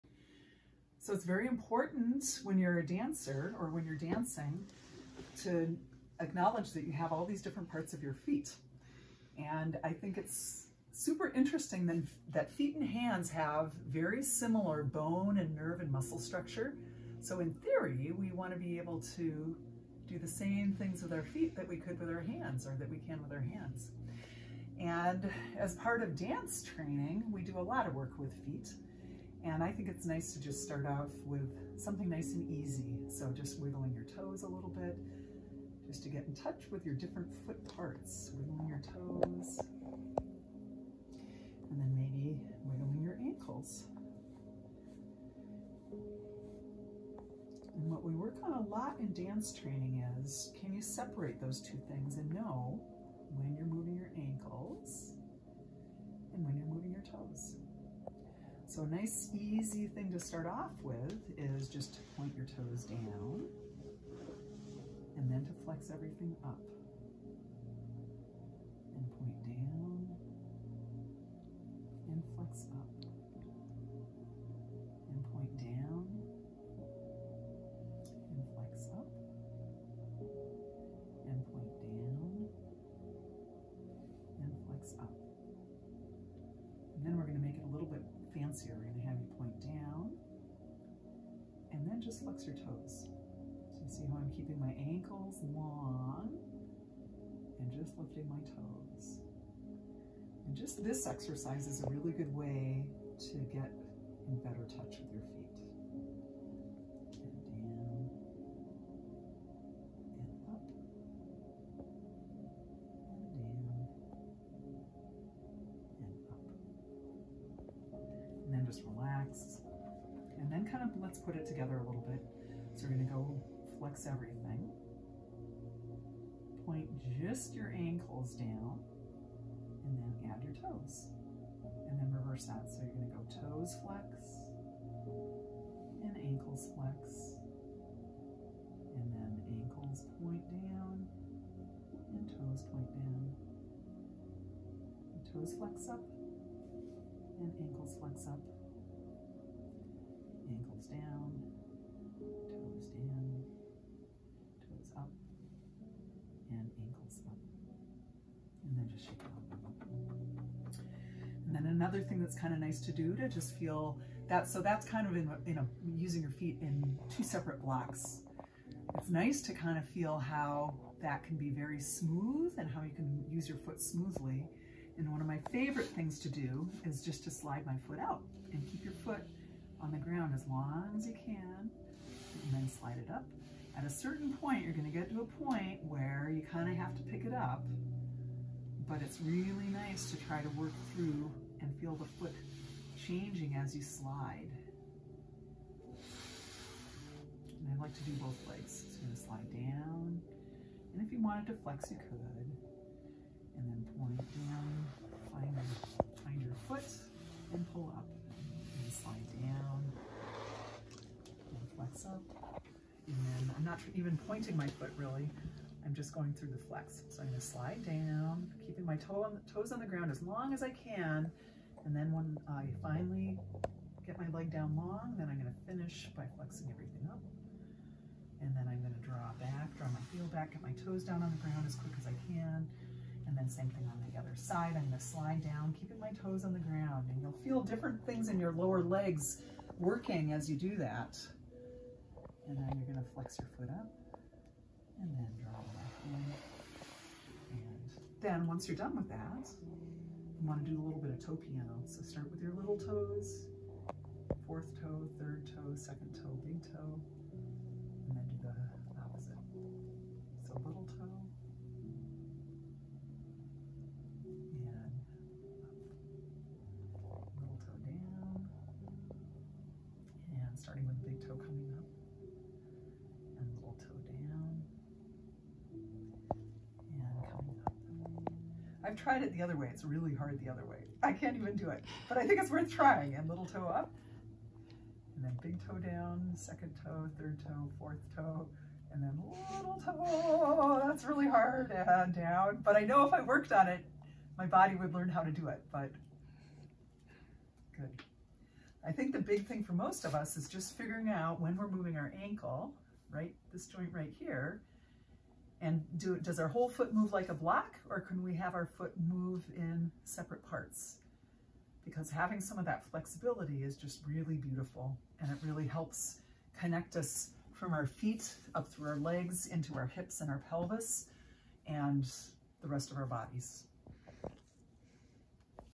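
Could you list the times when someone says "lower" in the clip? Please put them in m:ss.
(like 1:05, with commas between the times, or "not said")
3:58.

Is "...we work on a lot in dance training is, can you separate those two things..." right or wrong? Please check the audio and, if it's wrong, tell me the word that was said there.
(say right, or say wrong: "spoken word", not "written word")
right.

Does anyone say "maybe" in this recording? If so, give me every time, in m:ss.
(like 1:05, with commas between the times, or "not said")
0:41.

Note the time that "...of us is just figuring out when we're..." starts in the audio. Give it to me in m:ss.
5:00.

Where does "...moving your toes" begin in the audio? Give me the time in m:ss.
0:56.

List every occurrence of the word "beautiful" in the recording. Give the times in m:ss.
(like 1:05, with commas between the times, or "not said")
5:14.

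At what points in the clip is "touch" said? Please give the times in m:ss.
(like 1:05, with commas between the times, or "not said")
0:36, 1:44.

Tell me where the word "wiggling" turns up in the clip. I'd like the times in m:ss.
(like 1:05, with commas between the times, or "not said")
0:33, 0:38, 0:42.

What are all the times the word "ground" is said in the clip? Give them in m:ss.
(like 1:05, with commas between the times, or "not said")
2:59, 3:39, 3:51, 3:56.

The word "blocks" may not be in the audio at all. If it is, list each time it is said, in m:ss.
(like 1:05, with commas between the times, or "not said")
2:47, 5:07.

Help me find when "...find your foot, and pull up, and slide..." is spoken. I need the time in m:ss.
3:26.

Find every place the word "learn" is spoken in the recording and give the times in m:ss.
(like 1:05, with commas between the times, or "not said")
4:54.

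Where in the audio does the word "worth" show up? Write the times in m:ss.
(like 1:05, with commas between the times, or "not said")
4:42.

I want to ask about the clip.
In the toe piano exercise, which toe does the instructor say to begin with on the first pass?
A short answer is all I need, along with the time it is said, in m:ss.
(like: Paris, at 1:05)
little toes, at 4:12.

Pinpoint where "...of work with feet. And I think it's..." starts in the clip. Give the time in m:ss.
0:27.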